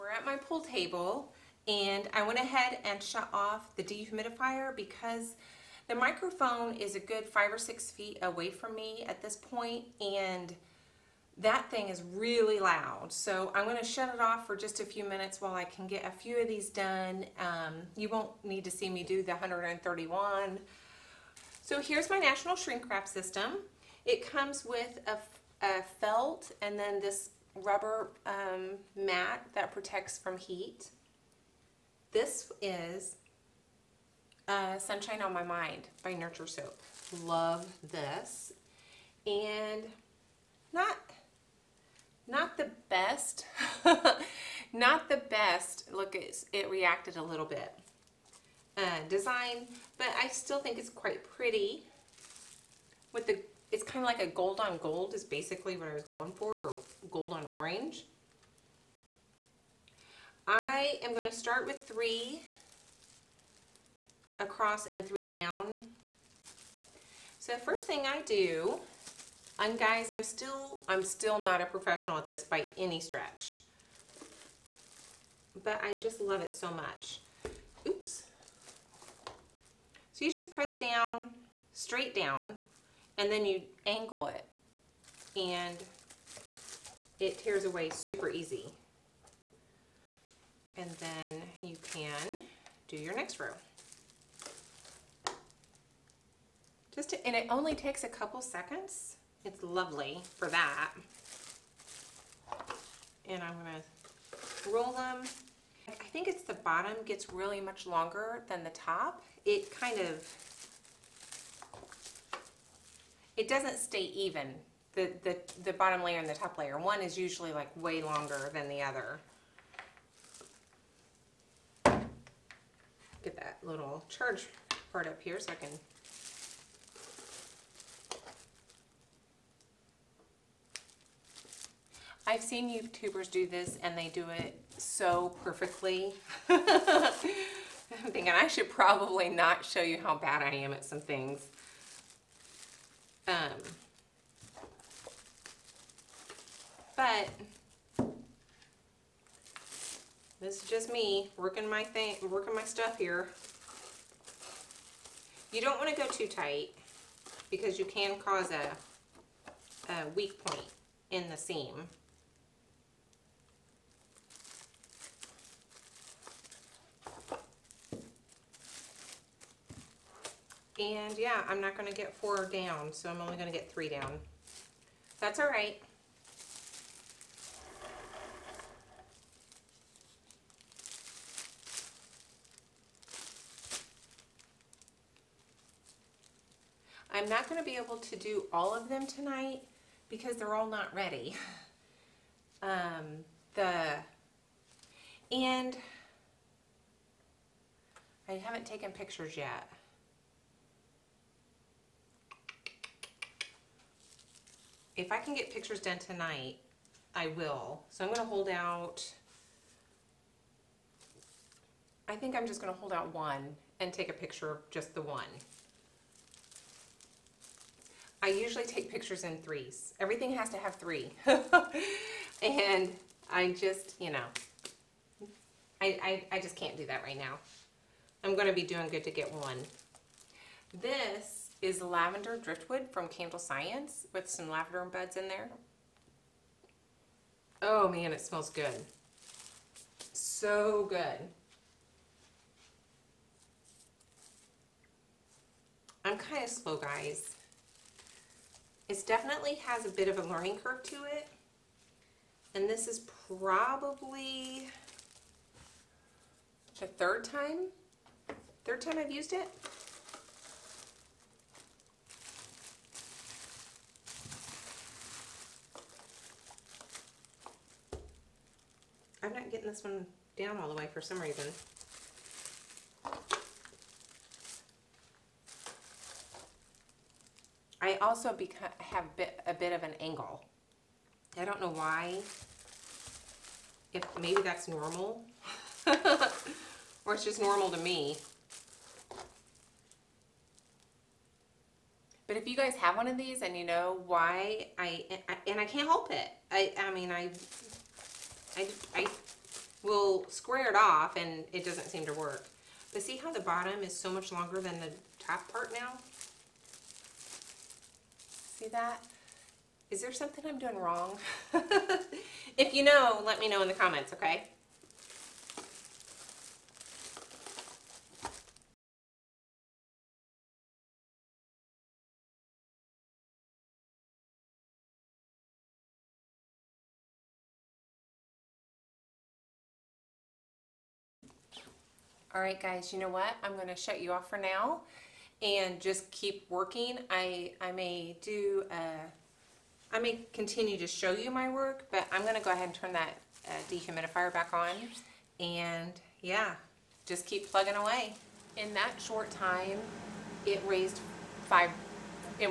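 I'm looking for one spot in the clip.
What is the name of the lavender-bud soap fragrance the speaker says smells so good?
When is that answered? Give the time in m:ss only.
3:51.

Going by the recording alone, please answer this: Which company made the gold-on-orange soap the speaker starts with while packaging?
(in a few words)
Nurture Soap.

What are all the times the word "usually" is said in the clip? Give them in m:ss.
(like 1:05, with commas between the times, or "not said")
1:57, 3:38.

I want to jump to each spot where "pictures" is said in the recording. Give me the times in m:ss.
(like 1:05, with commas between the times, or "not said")
3:18, 3:25, 3:34, 3:38.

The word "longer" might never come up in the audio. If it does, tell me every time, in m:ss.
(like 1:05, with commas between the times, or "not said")
1:47, 1:58, 5:04.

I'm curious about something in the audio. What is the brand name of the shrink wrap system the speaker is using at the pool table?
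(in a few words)
National.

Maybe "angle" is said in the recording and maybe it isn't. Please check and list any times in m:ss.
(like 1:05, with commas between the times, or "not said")
1:23, 4:40.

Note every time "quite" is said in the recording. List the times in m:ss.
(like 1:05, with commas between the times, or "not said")
0:50.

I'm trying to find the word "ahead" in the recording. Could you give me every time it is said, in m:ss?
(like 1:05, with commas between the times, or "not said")
0:02, 5:42.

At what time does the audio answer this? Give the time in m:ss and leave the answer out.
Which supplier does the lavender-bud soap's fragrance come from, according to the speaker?
3:53.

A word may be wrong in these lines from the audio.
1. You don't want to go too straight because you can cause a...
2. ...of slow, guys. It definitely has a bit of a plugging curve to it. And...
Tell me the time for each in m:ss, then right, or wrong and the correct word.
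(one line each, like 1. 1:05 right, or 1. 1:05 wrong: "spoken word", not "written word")
1. 2:35 wrong: "tight", not "straight"
2. 4:06 wrong: "learning", not "plugging".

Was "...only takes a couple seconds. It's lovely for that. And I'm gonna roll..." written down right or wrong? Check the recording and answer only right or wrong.
right.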